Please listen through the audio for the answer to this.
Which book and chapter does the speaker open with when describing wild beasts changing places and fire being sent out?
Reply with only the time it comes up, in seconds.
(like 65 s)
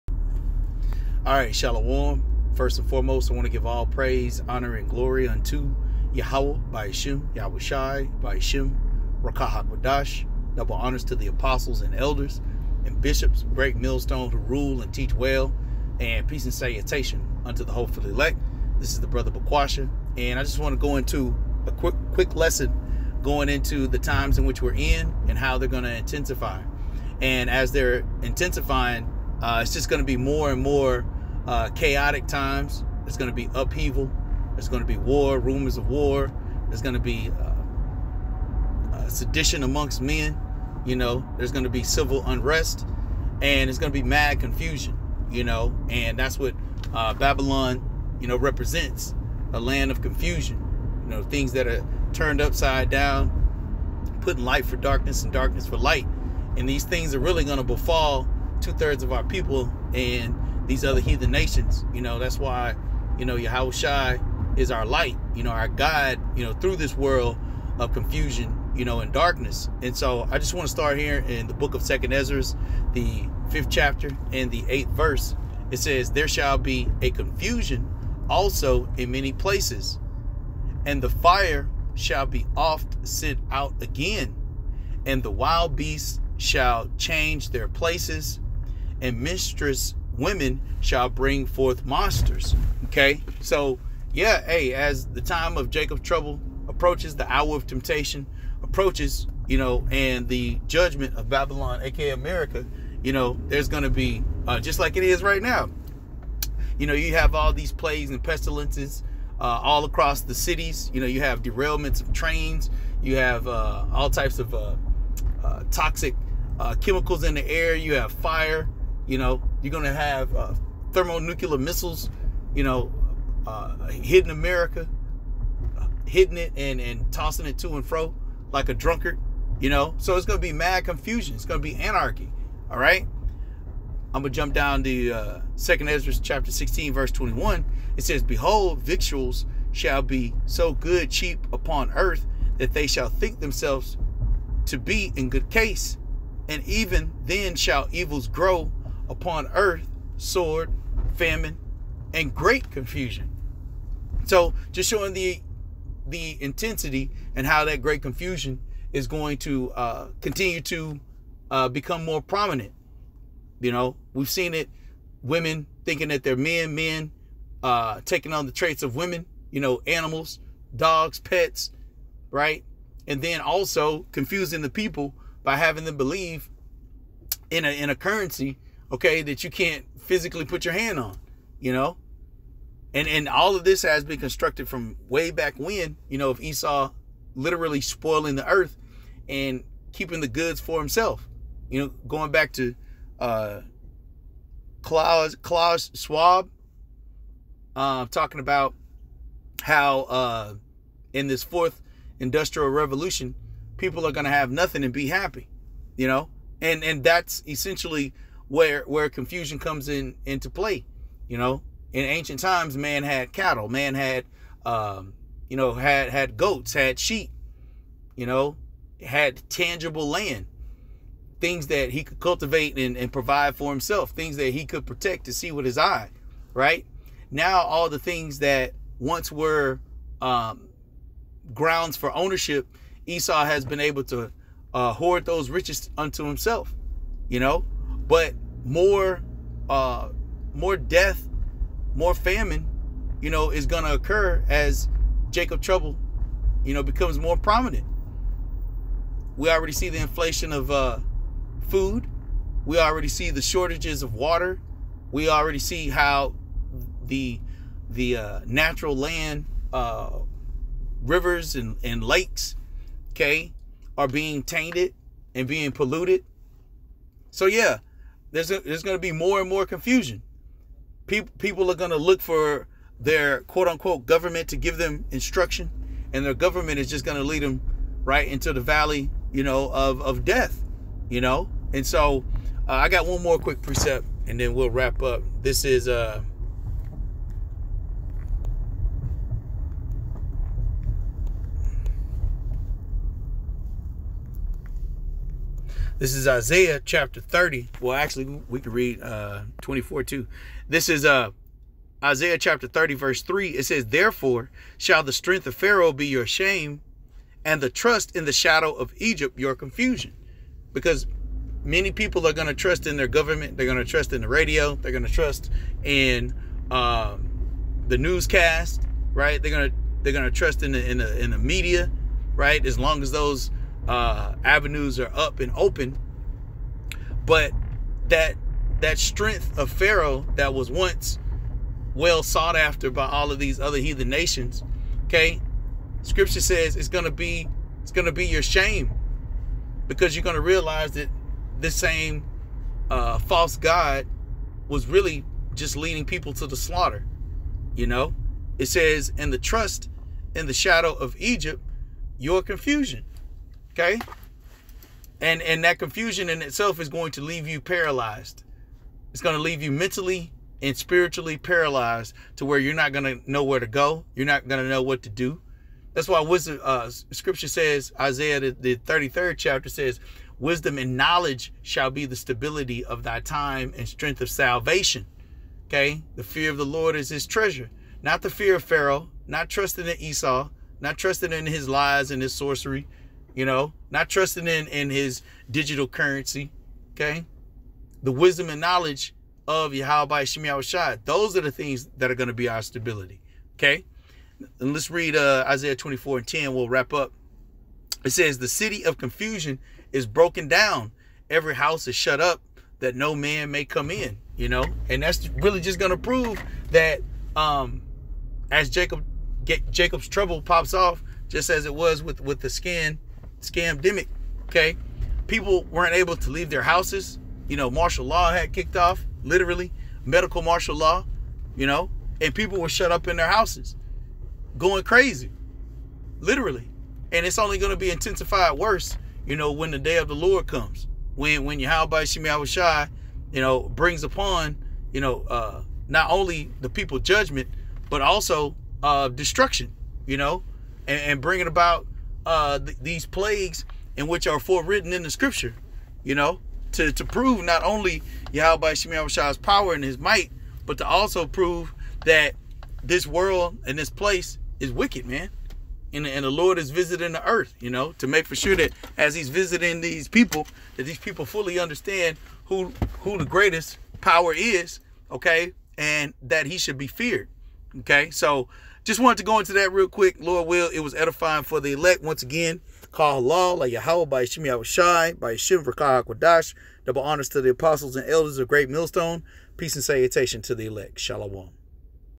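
71 s.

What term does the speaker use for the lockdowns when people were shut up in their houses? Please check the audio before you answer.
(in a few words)
Medical martial law.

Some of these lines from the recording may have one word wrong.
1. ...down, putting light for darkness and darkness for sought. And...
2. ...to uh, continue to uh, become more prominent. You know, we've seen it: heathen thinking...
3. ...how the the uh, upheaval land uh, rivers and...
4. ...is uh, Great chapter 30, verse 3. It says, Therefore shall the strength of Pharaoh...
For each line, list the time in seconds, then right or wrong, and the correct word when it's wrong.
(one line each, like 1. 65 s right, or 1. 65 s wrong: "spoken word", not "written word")
1. 52 s wrong: "light", not "sought"
2. 159 s wrong: "women", not "heathen"
3. 255 s wrong: "natural", not "upheaval"
4. 300 s wrong: "Isaiah", not "Great".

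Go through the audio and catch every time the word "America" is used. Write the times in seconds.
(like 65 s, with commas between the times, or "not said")
102 s, 124 s.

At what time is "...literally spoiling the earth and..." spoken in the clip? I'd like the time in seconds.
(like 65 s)
187 s.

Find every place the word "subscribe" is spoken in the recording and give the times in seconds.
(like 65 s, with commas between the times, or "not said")
not said.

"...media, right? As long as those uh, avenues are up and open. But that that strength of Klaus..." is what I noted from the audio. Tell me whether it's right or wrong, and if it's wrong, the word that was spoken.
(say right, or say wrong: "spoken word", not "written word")
wrong: "Pharaoh", not "Klaus".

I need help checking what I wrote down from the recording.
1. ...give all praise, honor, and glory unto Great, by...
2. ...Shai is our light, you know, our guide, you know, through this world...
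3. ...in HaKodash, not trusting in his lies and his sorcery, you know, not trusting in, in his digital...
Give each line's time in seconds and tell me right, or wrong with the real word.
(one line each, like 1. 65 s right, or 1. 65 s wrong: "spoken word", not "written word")
1. 3 s wrong: "Yahweh", not "Great"
2. 63 s right
3. 379 s wrong: "Esau", not "HaKodash".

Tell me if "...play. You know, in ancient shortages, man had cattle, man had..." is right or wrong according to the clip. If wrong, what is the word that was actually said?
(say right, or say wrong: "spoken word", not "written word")
wrong: "times", not "shortages".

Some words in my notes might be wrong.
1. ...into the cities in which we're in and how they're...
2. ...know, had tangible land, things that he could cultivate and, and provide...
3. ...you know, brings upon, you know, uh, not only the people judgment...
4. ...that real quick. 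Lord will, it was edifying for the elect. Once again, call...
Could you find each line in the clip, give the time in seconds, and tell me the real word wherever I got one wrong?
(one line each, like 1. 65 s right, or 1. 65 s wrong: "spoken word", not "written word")
1. 23 s wrong: "times", not "cities"
2. 218 s right
3. 433 s right
4. 469 s right.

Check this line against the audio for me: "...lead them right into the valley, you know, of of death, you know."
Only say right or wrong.
right.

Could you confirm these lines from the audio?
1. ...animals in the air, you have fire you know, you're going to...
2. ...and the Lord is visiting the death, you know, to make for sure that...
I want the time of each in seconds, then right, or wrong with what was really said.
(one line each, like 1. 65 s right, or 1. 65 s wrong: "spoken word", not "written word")
1. 116 s wrong: "chemicals", not "animals"
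2. 456 s wrong: "earth", not "death".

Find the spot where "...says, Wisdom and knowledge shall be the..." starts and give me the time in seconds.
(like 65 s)
369 s.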